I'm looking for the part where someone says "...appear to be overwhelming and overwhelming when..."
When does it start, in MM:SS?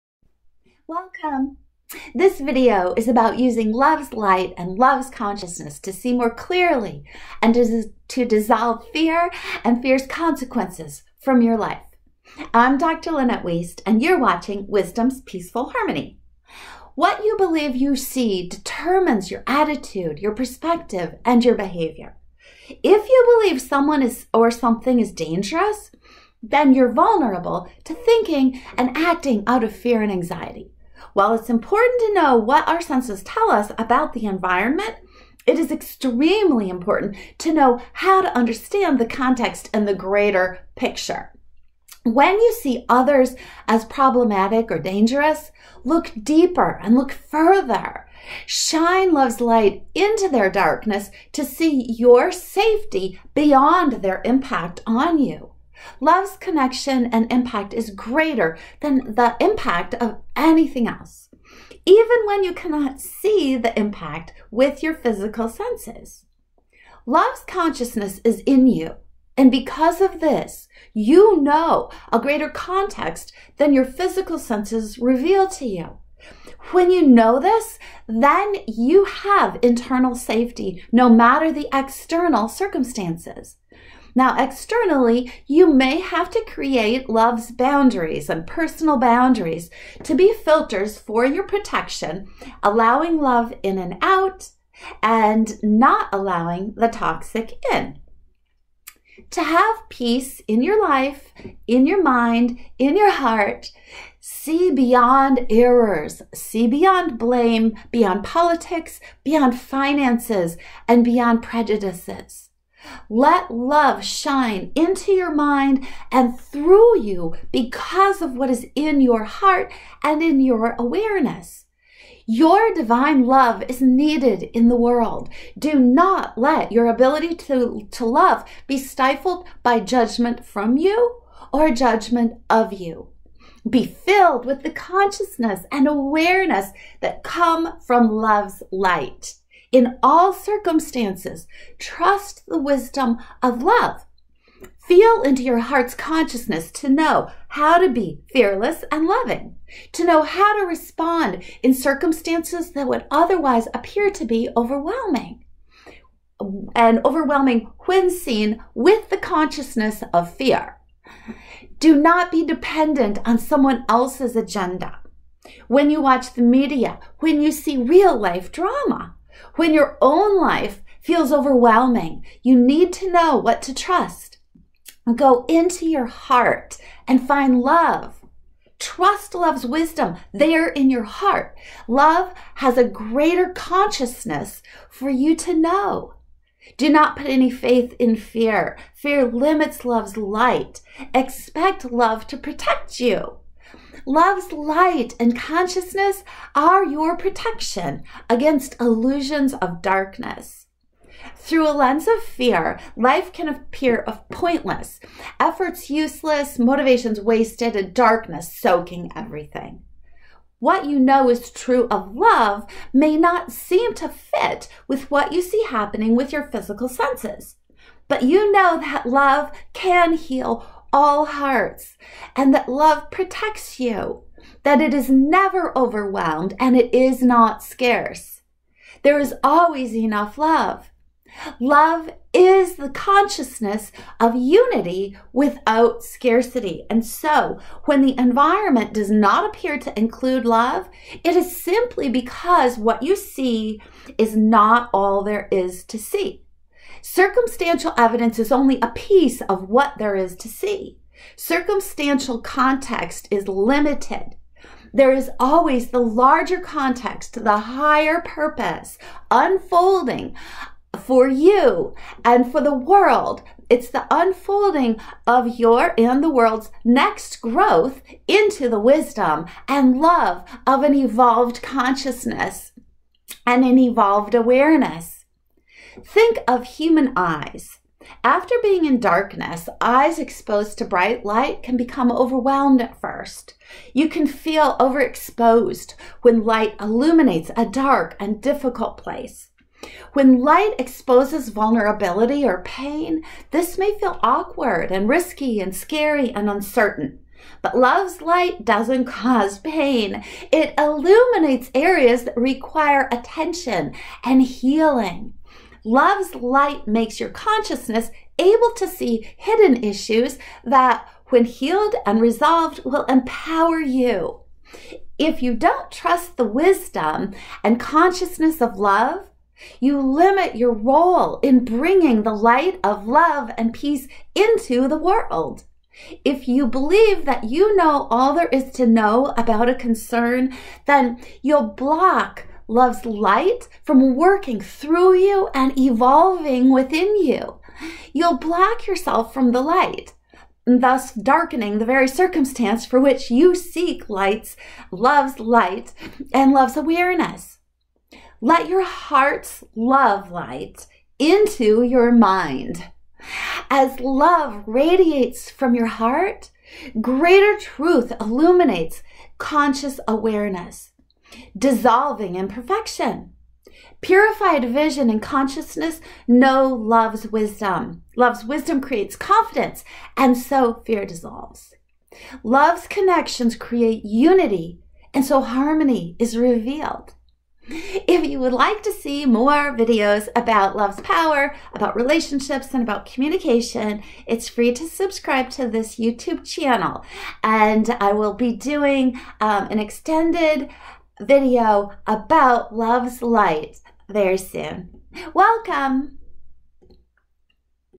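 02:33.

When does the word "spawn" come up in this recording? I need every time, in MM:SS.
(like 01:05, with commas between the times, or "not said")
not said.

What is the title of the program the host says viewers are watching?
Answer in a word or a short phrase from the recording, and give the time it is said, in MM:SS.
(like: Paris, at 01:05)
Wisdom's Peaceful Harmony, at 00:14.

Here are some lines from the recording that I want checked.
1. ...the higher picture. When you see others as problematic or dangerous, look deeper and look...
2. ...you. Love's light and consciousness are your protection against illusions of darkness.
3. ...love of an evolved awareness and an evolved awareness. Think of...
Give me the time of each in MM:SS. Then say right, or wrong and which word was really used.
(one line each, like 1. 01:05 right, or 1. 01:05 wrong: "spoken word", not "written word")
1. 00:39 wrong: "greater", not "higher"
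2. 03:12 right
3. 04:29 wrong: "consciousness", not "awareness".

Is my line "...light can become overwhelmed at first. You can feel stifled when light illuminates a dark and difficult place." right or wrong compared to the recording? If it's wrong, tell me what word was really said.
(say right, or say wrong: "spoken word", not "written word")
wrong: "overexposed", not "stifled".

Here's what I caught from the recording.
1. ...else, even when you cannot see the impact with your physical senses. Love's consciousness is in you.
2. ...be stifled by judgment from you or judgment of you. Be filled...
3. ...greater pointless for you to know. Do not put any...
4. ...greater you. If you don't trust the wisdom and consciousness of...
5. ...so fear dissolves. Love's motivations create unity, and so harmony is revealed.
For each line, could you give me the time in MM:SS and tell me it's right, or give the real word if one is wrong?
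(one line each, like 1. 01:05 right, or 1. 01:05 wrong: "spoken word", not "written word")
1. 01:00 right
2. 02:08 right
3. 03:02 wrong: "consciousness", not "pointless"
4. 05:13 wrong: "empower", not "greater"
5. 06:10 wrong: "connections", not "motivations".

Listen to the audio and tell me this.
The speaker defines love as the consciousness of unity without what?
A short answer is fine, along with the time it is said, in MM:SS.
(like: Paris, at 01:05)
Scarcity, at 03:56.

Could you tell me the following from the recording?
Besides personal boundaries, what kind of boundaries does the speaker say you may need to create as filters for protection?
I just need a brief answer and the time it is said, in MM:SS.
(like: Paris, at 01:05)
Love's boundaries, at 01:27.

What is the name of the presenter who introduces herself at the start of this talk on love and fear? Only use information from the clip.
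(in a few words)
Dr. Lynette Wiest.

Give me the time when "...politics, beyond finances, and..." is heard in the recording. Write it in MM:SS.
01:48.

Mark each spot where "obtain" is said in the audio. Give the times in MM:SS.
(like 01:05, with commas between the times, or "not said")
not said.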